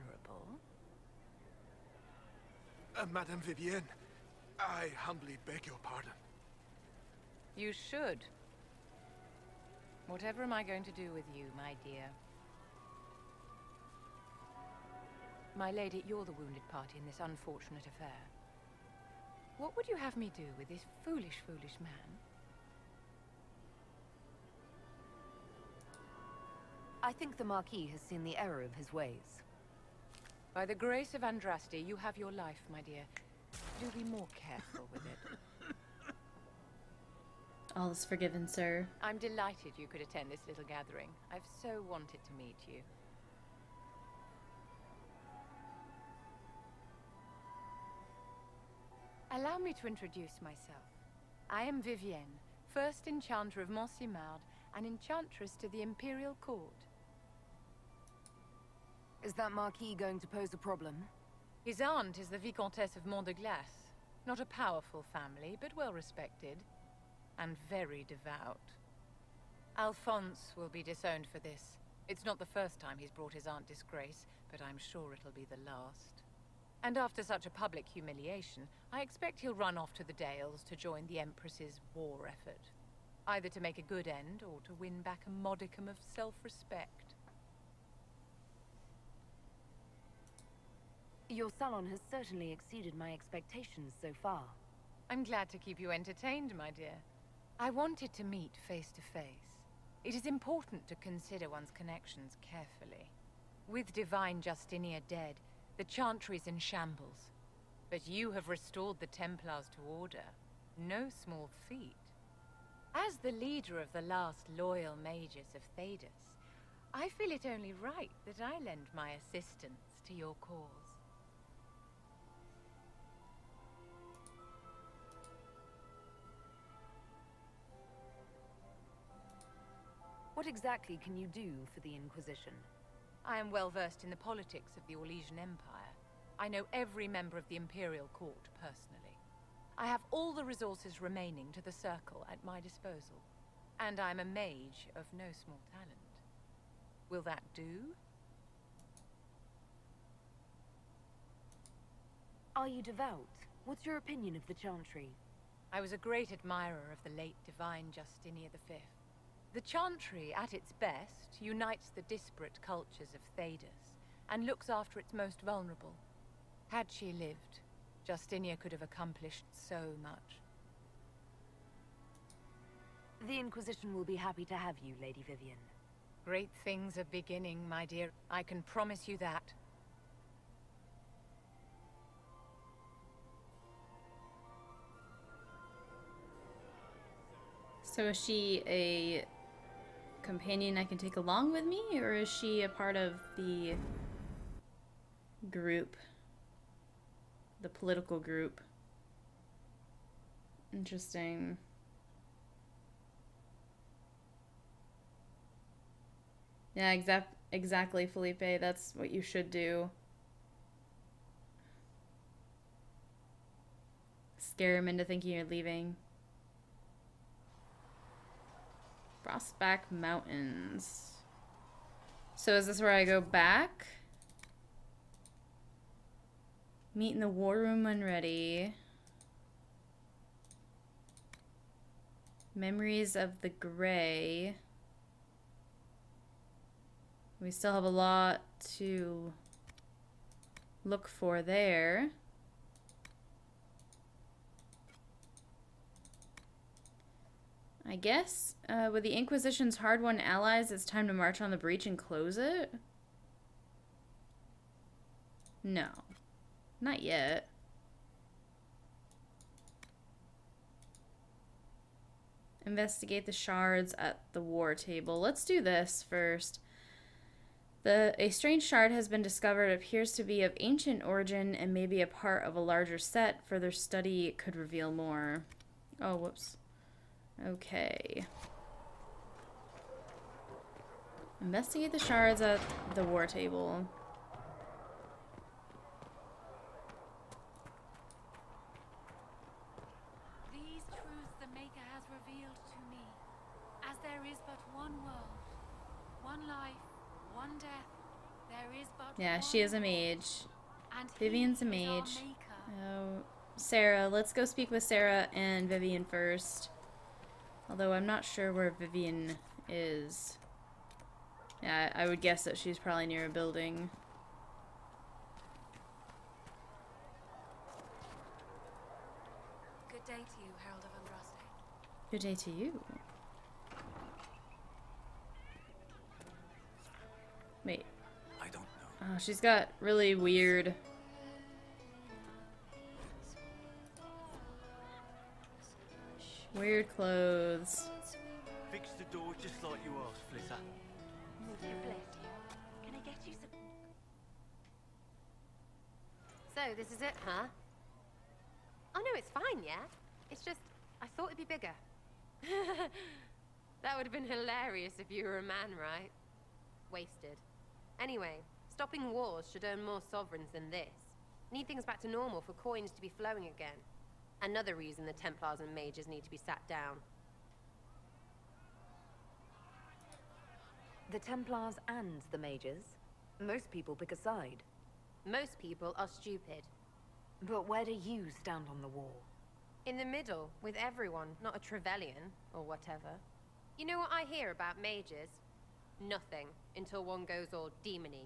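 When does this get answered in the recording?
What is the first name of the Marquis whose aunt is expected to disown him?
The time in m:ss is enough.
1:09.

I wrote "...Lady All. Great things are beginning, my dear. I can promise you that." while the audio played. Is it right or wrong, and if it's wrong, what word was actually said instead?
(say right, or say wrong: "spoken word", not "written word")
wrong: "Vivienne", not "All".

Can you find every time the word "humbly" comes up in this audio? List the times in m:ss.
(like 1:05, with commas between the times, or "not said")
0:04.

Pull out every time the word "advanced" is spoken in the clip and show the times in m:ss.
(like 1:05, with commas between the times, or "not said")
not said.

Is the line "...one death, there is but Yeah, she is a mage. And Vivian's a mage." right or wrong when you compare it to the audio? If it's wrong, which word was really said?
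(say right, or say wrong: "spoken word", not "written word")
right.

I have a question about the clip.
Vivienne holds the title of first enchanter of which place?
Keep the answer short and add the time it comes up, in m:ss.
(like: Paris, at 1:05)
Montsimmard, at 0:53.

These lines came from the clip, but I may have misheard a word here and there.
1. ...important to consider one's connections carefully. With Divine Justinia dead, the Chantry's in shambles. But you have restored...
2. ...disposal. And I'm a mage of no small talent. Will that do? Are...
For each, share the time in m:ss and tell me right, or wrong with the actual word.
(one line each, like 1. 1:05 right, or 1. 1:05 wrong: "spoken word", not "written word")
1. 1:40 right
2. 2:22 right.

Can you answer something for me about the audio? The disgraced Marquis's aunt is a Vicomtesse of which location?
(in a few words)
Mont de Glace.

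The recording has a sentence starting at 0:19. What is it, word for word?
What would you have me do with this foolish, foolish man?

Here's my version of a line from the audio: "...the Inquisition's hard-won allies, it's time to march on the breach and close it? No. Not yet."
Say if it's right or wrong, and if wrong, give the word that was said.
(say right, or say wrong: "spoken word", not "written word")
right.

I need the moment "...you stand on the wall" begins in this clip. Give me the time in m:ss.
6:17.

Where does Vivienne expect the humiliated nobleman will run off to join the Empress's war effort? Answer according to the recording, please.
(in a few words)
The Dales.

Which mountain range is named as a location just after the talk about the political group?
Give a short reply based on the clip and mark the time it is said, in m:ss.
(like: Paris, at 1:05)
Frostback Mountains, at 3:39.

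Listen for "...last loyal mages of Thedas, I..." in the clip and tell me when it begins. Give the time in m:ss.
1:54.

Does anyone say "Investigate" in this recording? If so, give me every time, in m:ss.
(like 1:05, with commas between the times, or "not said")
4:22, 4:41.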